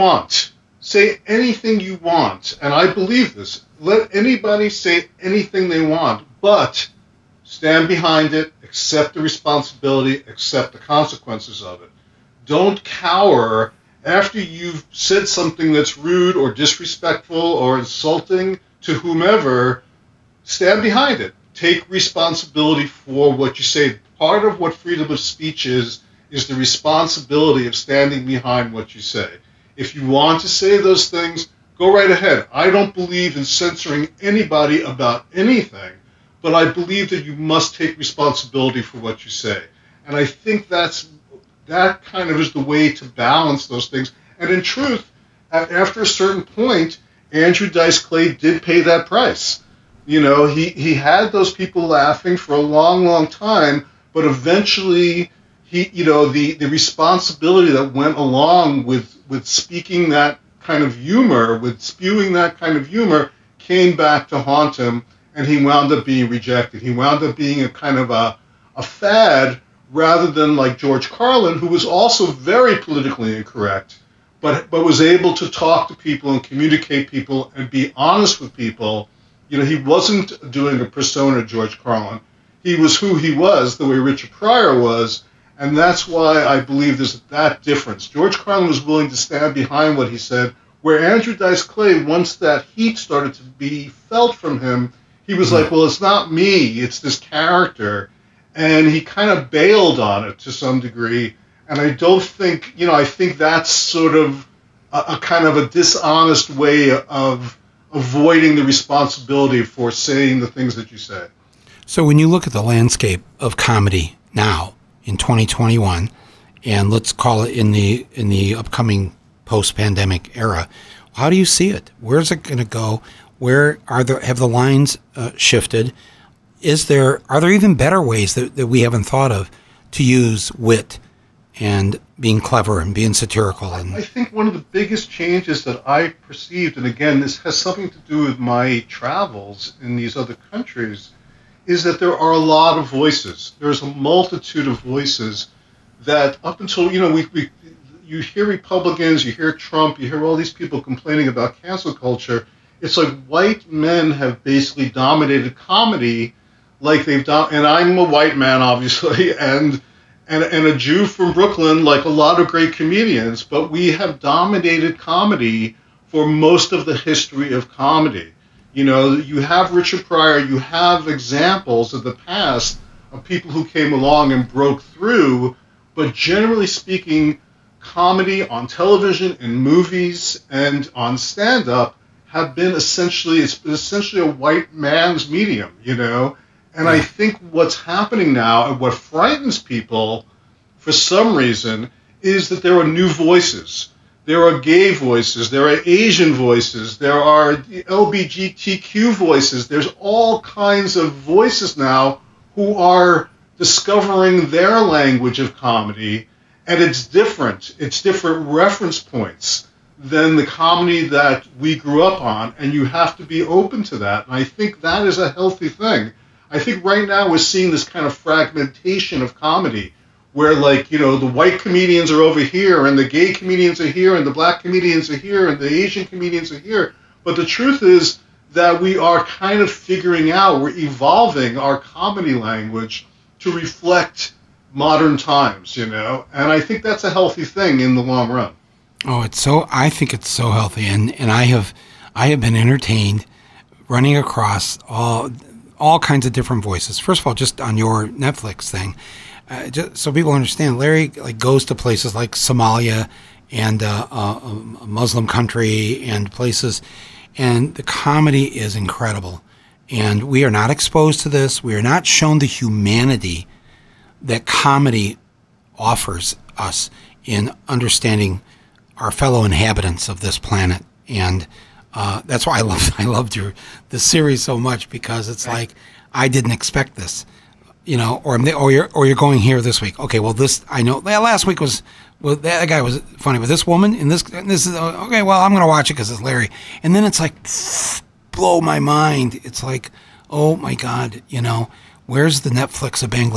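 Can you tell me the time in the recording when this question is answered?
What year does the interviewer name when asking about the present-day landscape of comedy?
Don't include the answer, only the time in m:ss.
1:55.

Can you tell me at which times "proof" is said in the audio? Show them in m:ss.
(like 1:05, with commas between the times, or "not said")
not said.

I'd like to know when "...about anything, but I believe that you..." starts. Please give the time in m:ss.
0:34.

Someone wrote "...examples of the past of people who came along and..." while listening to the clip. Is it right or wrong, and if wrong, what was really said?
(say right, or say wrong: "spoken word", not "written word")
right.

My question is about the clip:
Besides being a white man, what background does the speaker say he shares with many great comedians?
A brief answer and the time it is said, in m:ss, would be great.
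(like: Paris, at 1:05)
A Jew from Brooklyn, at 2:40.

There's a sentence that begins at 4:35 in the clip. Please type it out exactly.
like I didn't expect this, you know, or I'm or you're or you're going here this week.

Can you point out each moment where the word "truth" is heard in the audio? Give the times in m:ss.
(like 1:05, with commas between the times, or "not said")
0:44, 3:47.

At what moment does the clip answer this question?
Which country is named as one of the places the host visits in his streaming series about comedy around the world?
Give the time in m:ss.
4:12.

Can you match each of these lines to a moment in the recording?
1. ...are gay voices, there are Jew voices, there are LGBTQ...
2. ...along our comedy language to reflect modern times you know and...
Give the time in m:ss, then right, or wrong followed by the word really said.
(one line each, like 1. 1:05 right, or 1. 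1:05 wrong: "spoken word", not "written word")
1. 3:14 wrong: "Asian", not "Jew"
2. 3:50 wrong: "evolving", not "along".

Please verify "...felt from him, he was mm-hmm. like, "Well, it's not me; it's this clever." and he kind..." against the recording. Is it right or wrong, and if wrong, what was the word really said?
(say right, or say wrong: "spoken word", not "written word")
wrong: "character", not "clever".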